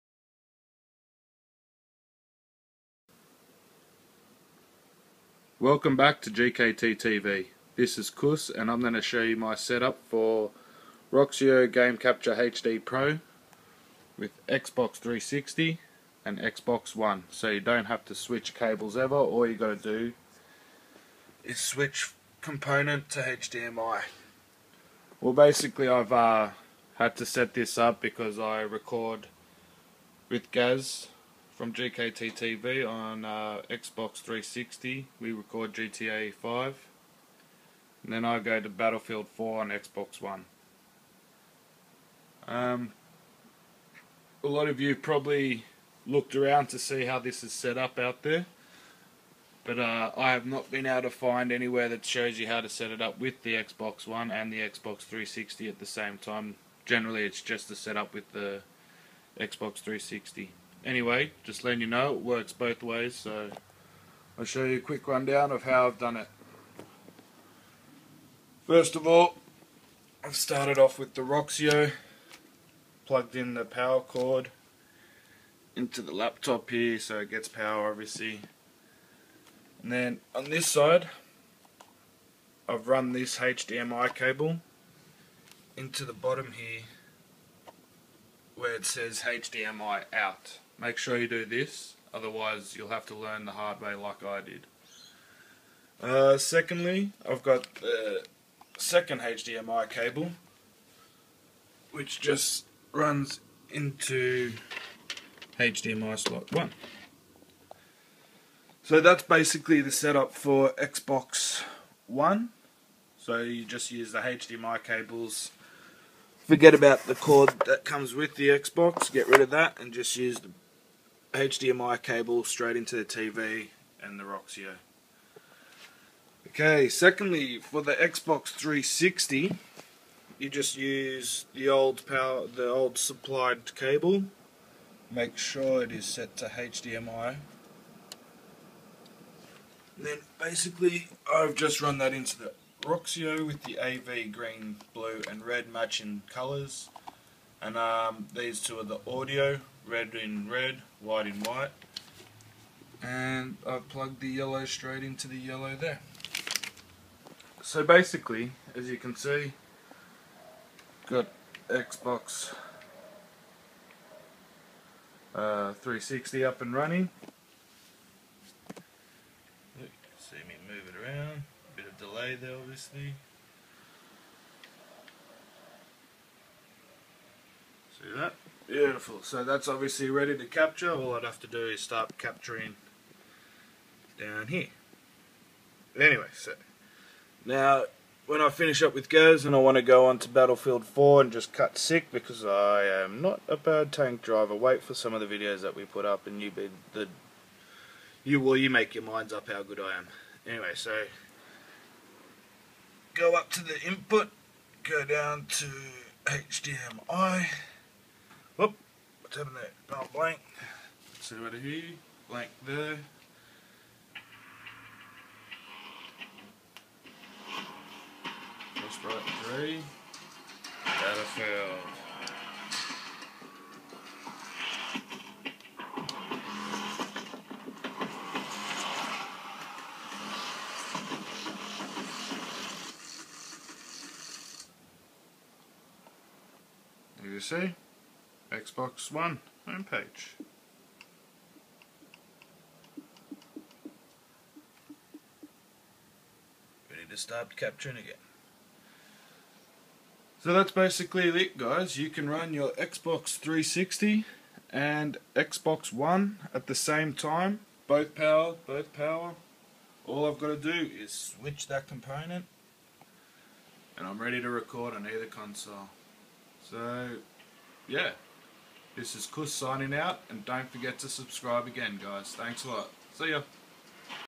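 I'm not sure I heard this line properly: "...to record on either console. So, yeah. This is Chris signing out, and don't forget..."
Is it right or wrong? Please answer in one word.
right.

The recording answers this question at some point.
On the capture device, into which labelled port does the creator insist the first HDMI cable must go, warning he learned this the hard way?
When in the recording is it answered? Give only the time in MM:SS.
01:29.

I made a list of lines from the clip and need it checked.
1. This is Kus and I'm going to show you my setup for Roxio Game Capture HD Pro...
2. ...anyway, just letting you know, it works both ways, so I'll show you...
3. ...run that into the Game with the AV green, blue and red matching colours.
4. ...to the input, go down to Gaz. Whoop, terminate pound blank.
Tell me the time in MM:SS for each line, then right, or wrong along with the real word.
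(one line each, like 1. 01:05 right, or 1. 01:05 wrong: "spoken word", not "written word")
1. 00:07 right
2. 01:00 right
3. 02:21 wrong: "Roxio", not "Game"
4. 03:23 wrong: "HDMI", not "Gaz".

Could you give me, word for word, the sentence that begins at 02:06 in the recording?
Okay, secondly, for the Xbox 360, you just use the old power, the old supplied cable.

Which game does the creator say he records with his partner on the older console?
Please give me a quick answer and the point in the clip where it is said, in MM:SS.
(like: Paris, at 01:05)
GTA 5, at 00:35.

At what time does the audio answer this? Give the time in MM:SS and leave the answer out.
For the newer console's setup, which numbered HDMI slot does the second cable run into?
01:45.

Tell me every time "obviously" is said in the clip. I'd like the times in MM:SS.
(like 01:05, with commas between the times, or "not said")
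01:17, 02:52, 02:59.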